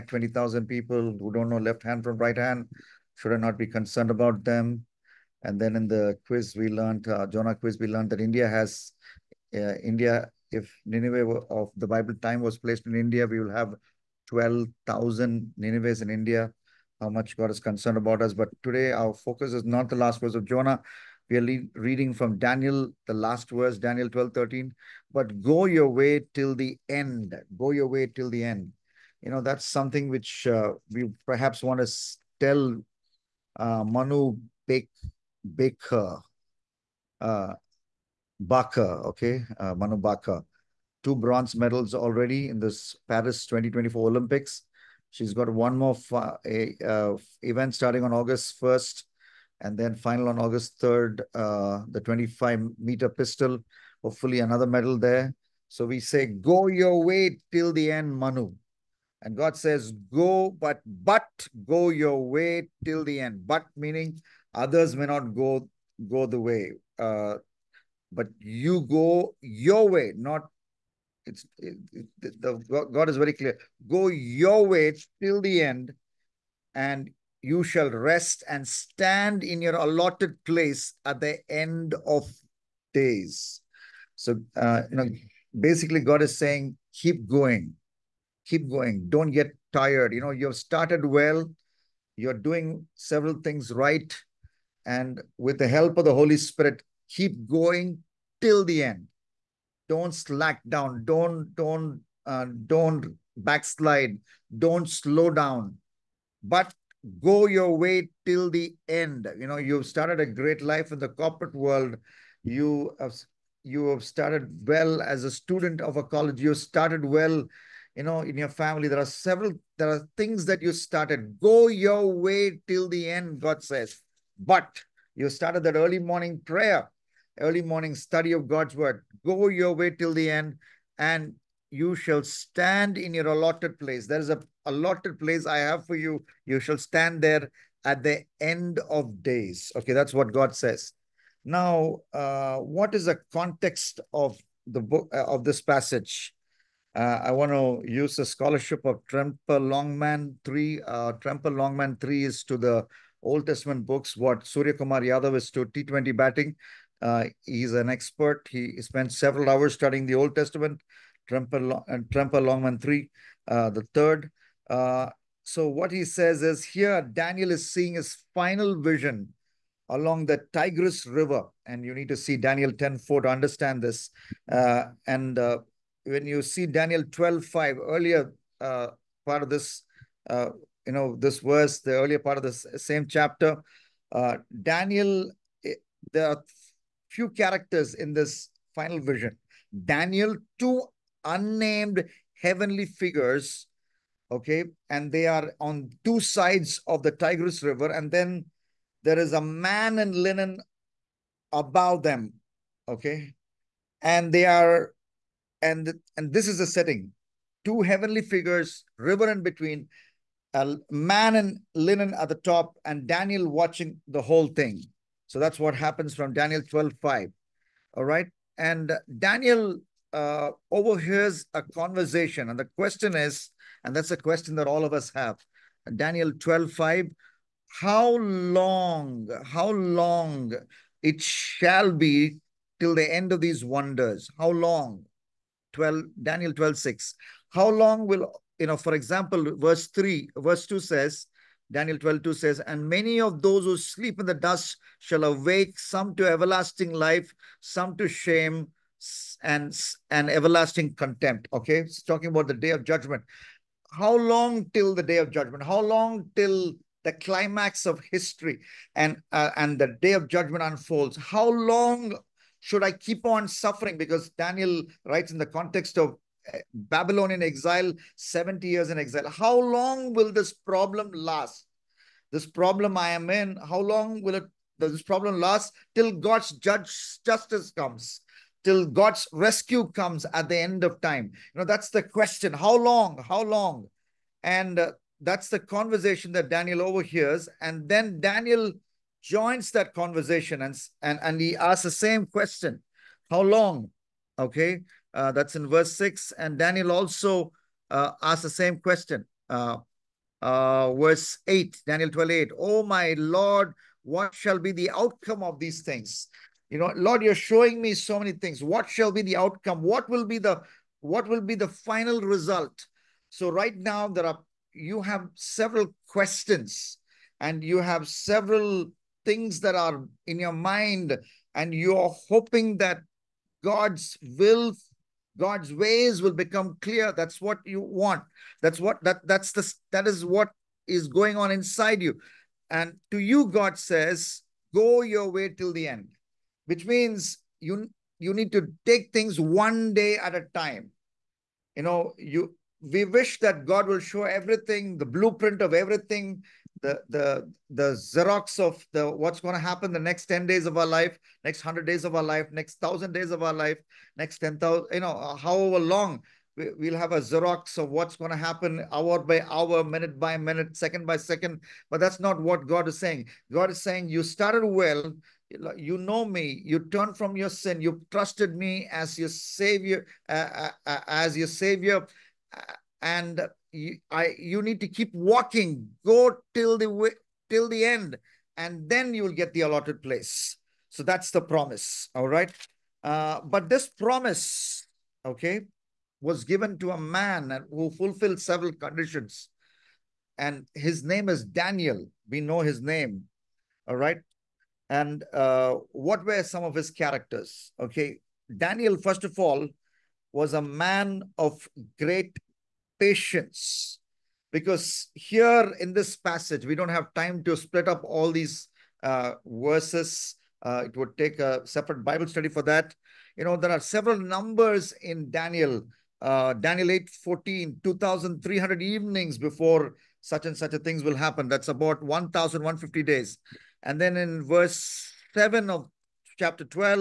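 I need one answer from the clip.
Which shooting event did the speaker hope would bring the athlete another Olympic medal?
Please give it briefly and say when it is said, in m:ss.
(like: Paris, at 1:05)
25 meter pistol, at 0:51.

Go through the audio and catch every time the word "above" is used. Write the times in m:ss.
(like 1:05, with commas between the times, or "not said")
3:21.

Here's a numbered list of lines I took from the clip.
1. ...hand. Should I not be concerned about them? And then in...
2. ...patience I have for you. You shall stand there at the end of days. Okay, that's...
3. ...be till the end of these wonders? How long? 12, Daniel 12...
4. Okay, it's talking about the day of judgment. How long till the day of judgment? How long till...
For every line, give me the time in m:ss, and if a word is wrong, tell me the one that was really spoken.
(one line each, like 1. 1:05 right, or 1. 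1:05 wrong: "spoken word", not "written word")
1. 0:02 right
2. 2:15 wrong: "place", not "patience"
3. 3:51 right
4. 4:11 right.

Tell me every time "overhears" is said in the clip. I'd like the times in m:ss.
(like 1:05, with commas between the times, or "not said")
3:40, 4:46.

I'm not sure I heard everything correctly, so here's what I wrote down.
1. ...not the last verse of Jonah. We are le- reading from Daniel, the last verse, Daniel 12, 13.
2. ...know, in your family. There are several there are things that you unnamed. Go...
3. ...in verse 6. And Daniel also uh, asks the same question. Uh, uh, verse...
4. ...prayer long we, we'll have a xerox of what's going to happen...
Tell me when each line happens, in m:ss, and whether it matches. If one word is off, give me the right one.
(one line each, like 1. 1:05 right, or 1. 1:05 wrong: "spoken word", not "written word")
1. 0:19 right
2. 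1:58 wrong: "started", not "unnamed"
3. 4:55 right
4. 5:55 wrong: "however", not "prayer".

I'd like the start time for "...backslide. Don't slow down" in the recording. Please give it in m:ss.
1:43.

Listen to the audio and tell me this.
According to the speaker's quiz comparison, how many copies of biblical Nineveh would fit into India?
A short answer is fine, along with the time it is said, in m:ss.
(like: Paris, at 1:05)
12,000, at 0:14.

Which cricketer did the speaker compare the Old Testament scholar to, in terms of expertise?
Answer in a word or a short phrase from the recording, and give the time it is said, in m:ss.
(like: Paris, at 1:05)
Surya Kumar Yadav, at 2:34.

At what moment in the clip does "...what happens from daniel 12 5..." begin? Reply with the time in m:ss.
3:35.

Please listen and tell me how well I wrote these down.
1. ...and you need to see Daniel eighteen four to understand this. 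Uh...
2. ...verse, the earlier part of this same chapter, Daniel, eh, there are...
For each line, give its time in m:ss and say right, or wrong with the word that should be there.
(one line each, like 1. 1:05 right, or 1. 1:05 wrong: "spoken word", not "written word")
1. 2:51 wrong: "ten", not "eighteen"
2. 3:01 right.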